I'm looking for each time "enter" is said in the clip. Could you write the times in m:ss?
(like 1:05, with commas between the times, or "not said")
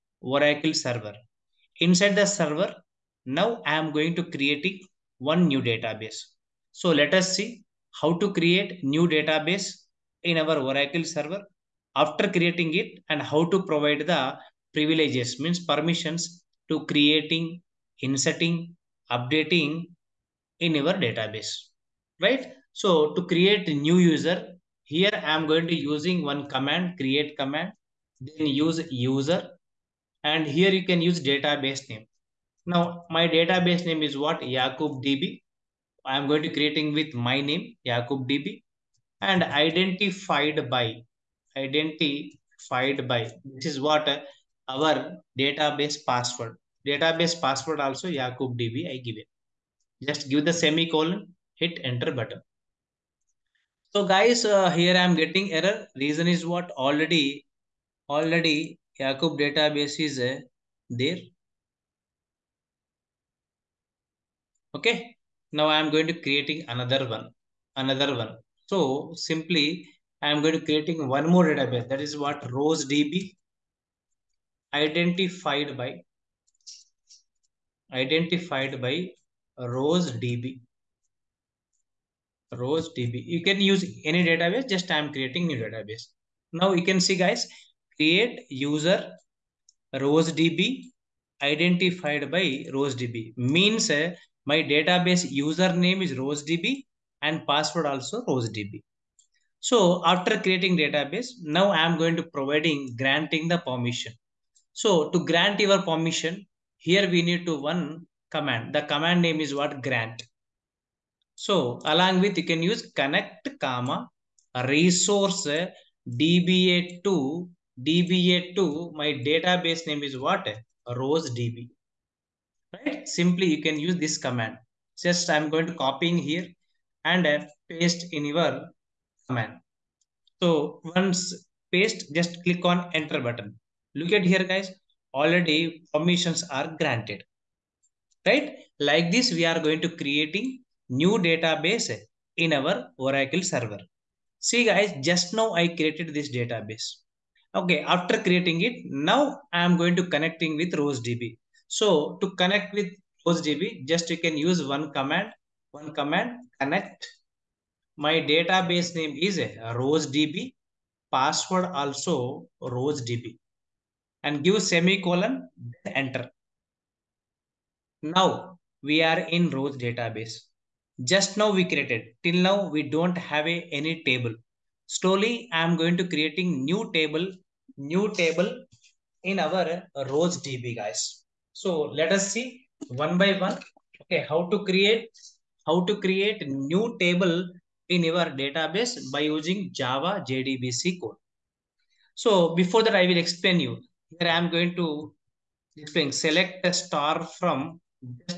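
0:51, 2:12, 2:45.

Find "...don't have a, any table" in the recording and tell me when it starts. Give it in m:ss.
2:52.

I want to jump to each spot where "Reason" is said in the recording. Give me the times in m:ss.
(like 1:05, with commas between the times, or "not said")
0:56.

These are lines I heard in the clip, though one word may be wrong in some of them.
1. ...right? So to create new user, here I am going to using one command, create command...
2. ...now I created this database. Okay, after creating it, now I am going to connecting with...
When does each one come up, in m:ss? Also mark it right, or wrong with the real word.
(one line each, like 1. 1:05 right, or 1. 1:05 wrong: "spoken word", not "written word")
1. 0:22 right
2. 2:25 right.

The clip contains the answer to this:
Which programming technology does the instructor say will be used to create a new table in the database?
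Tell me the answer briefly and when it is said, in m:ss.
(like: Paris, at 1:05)
Java JDBC, at 3:09.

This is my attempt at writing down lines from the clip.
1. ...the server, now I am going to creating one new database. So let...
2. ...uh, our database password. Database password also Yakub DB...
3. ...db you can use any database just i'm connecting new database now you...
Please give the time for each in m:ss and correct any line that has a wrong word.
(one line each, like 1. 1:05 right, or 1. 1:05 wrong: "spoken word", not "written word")
1. 0:02 right
2. 0:44 right
3. 1:22 wrong: "creating", not "connecting".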